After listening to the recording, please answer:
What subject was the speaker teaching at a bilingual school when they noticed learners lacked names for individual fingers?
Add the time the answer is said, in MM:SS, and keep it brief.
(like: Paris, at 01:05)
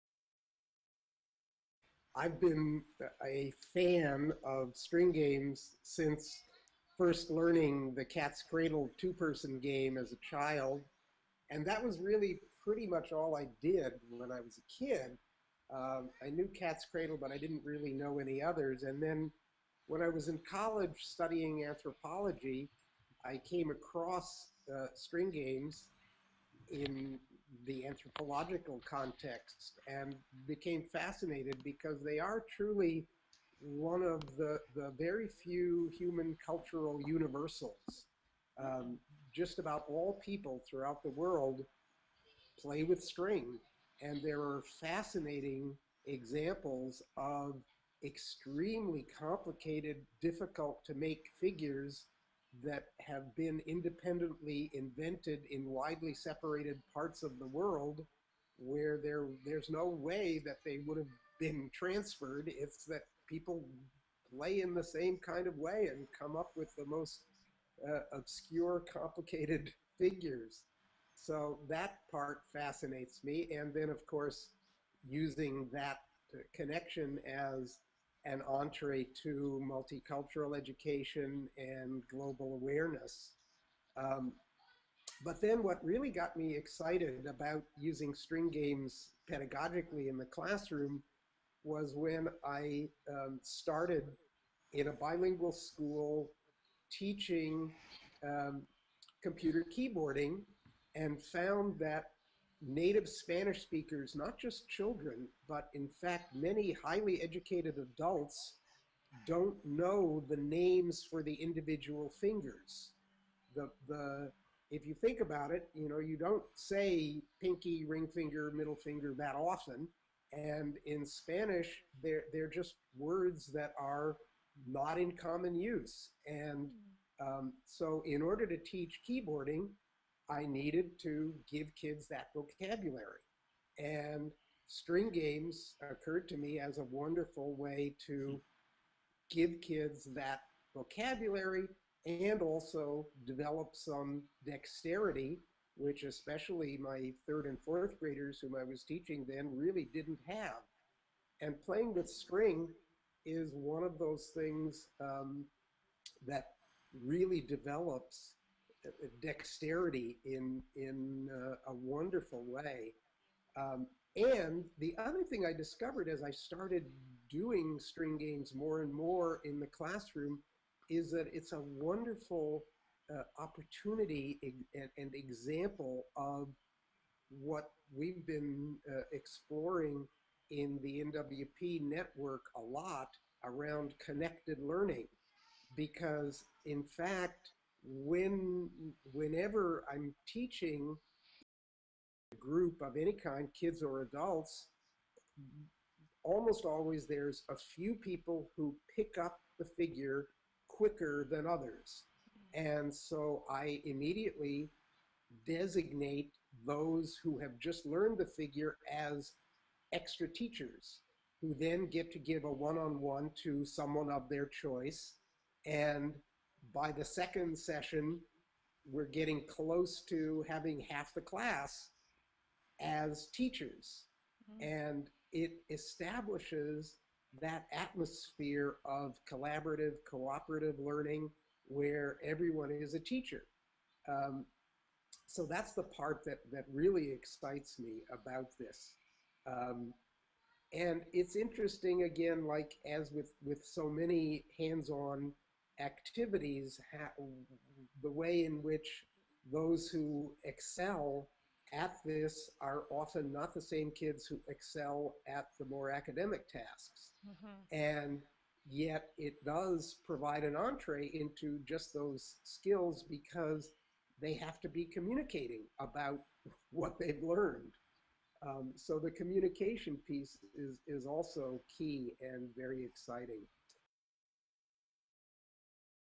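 computer keyboarding, at 01:39.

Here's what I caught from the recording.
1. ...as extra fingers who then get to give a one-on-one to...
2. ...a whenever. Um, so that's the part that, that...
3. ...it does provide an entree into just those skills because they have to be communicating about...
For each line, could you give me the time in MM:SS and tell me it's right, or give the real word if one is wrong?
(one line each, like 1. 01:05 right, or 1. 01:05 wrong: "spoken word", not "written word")
1. 03:28 wrong: "teachers", not "fingers"
2. 03:52 wrong: "teacher", not "whenever"
3. 04:19 right.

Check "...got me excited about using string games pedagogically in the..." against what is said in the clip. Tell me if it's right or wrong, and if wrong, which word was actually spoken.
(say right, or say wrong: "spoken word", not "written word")
right.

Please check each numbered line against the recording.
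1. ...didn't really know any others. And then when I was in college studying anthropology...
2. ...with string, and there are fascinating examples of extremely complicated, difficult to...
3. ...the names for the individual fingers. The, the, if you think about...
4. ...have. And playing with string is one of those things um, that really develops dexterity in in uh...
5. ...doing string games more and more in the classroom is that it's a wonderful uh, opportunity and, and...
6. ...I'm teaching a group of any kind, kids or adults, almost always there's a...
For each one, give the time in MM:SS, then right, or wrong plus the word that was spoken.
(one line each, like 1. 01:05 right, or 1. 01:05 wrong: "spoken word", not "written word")
1. 00:17 right
2. 00:42 right
3. 01:50 right
4. 02:30 right
5. 02:47 right
6. 03:09 right.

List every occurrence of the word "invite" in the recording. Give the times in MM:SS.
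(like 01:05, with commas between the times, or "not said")
not said.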